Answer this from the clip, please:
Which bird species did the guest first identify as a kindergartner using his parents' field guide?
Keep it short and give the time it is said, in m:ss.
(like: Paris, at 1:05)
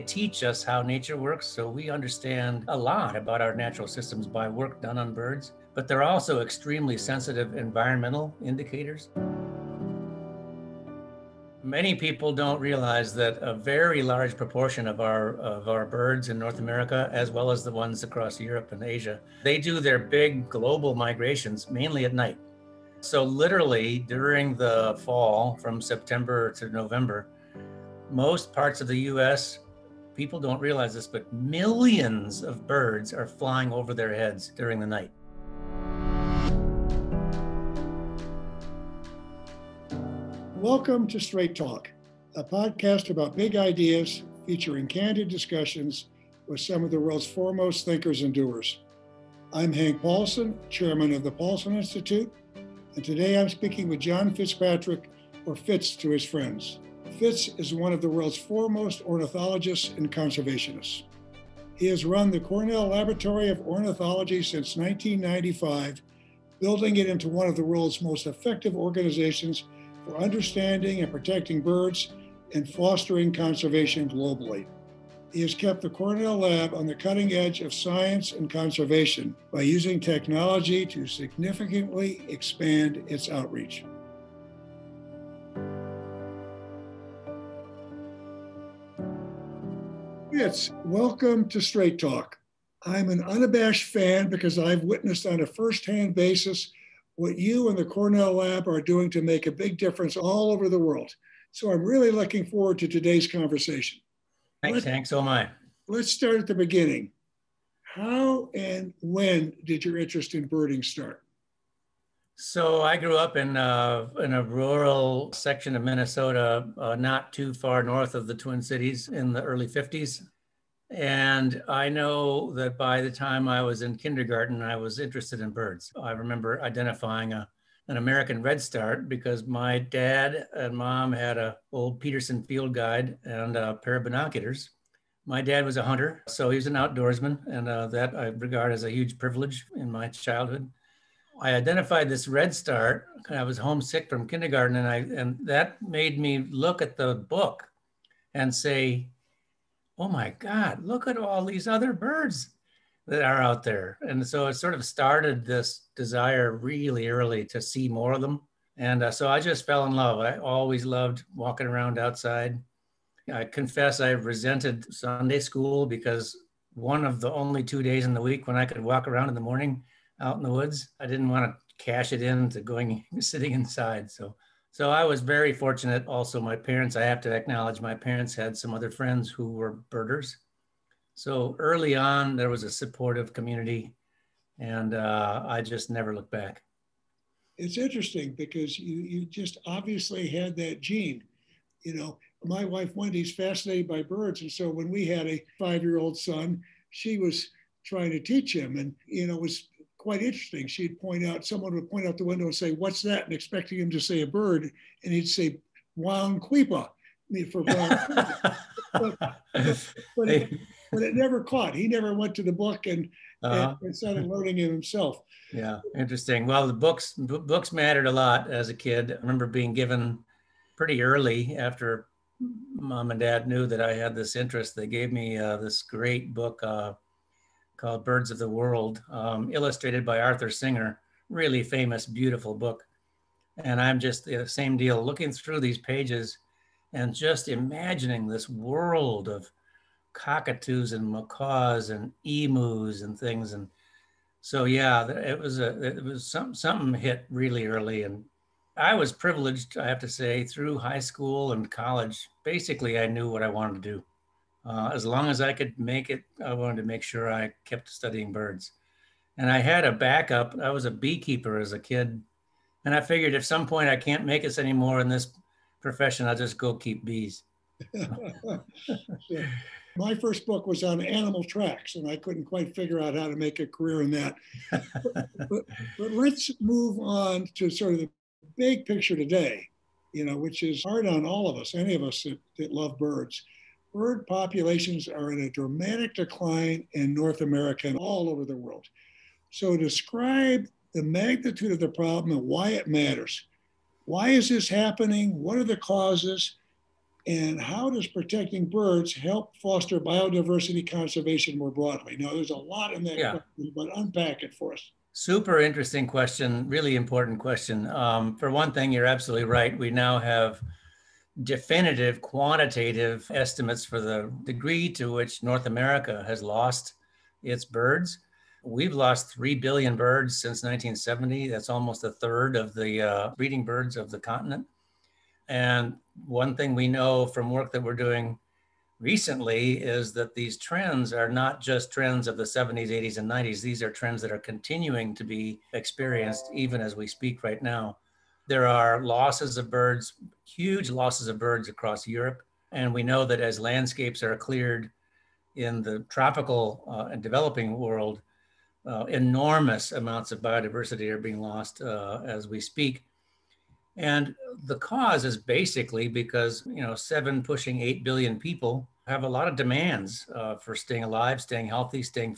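American redstart, at 2:07.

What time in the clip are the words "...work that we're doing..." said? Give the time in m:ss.
5:27.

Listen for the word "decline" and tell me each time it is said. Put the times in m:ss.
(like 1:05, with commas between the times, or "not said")
4:46.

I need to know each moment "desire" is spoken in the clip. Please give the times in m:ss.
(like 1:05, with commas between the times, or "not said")
2:35.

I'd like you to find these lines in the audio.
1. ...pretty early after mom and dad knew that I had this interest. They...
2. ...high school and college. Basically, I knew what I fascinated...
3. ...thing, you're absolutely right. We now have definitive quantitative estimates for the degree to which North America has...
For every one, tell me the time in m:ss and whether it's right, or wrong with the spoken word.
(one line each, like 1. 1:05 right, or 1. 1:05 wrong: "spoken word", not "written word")
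1. 3:40 right
2. 4:10 wrong: "wanted", not "fascinated"
3. 5:08 right.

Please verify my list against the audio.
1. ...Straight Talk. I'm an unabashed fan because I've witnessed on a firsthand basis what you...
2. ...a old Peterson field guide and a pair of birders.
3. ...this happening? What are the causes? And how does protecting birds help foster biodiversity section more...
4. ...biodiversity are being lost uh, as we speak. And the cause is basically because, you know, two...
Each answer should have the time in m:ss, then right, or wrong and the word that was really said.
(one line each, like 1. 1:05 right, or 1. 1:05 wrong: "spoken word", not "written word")
1. 1:31 right
2. 2:11 wrong: "binoculars", not "birders"
3. 4:54 wrong: "conservation", not "section"
4. 5:50 wrong: "seven", not "two".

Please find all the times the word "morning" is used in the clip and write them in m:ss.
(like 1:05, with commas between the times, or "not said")
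2:49.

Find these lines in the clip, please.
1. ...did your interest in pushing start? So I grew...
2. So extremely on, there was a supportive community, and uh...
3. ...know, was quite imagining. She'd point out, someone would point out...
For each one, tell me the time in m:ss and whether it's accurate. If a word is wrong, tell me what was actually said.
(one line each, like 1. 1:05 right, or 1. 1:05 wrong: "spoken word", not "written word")
1. 1:49 wrong: "birding", not "pushing"
2. 3:01 wrong: "early", not "extremely"
3. 3:19 wrong: "interesting", not "imagining".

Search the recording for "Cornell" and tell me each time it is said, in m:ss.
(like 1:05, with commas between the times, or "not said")
1:02, 1:15, 1:37.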